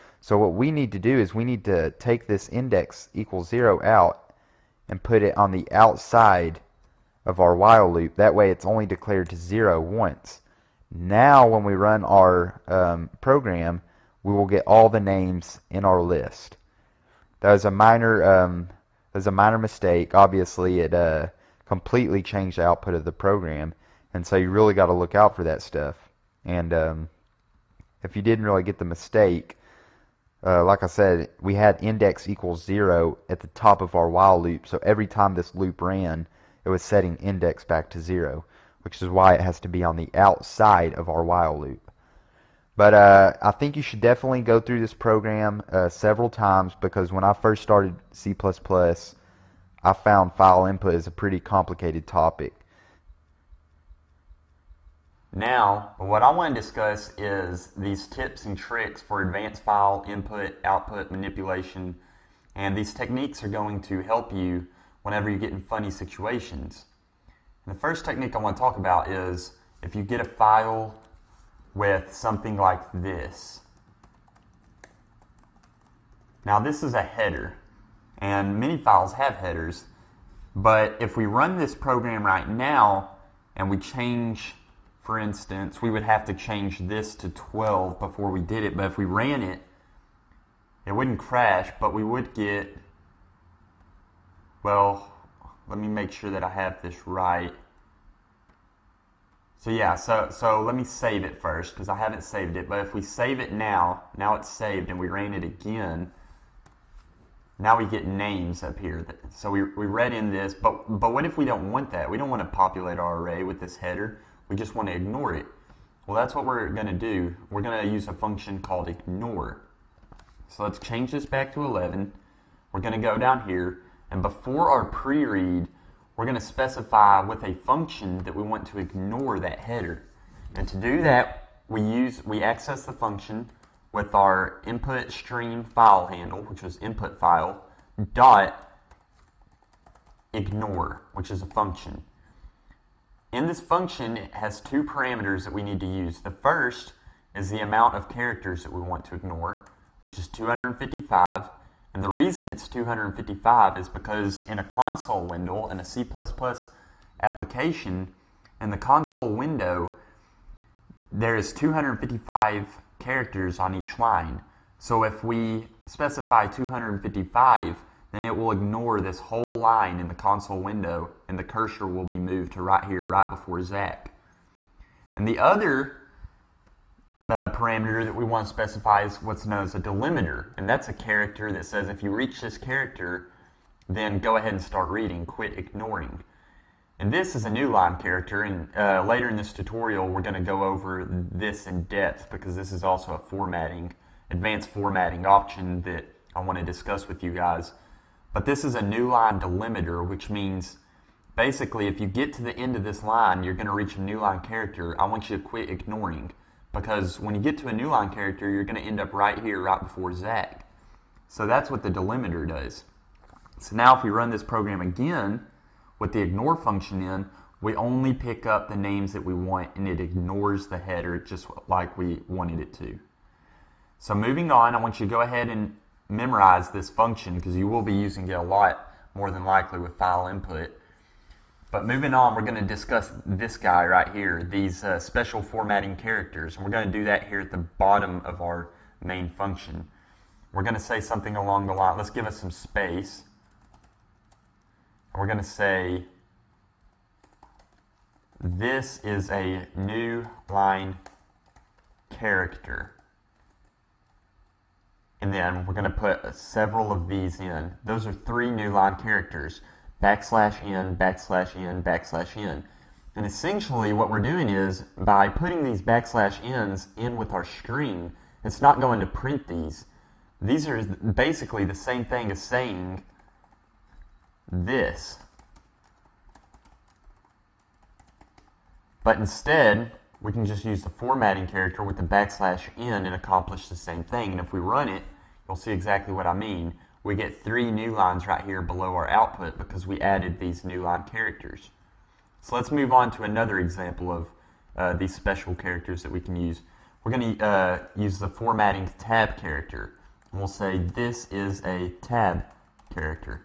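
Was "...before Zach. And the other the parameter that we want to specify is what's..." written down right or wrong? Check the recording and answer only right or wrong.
right.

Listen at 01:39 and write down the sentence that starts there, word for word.
So yeah, so, so let me save it first because I haven't saved it.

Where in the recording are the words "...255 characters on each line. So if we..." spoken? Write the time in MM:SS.
02:41.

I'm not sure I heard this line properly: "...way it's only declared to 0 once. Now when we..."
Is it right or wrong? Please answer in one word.
right.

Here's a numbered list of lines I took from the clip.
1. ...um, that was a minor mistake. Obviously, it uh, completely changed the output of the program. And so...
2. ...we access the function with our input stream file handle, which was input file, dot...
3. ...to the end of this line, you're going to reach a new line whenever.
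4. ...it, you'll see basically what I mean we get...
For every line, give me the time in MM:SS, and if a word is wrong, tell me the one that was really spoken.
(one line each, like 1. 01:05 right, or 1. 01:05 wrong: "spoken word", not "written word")
1. 00:18 right
2. 02:12 right
3. 03:22 wrong: "character", not "whenever"
4. 04:44 wrong: "exactly", not "basically".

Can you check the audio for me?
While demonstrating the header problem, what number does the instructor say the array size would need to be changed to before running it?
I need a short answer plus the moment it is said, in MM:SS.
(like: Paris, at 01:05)
12, at 01:27.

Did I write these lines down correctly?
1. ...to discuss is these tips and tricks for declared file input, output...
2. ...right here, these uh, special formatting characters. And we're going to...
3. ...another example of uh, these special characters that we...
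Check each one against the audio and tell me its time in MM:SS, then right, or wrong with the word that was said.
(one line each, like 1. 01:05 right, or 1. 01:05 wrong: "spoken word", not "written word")
1. 00:56 wrong: "advanced", not "declared"
2. 03:53 right
3. 04:53 right.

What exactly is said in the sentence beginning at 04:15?
And then we're going to put several of these in.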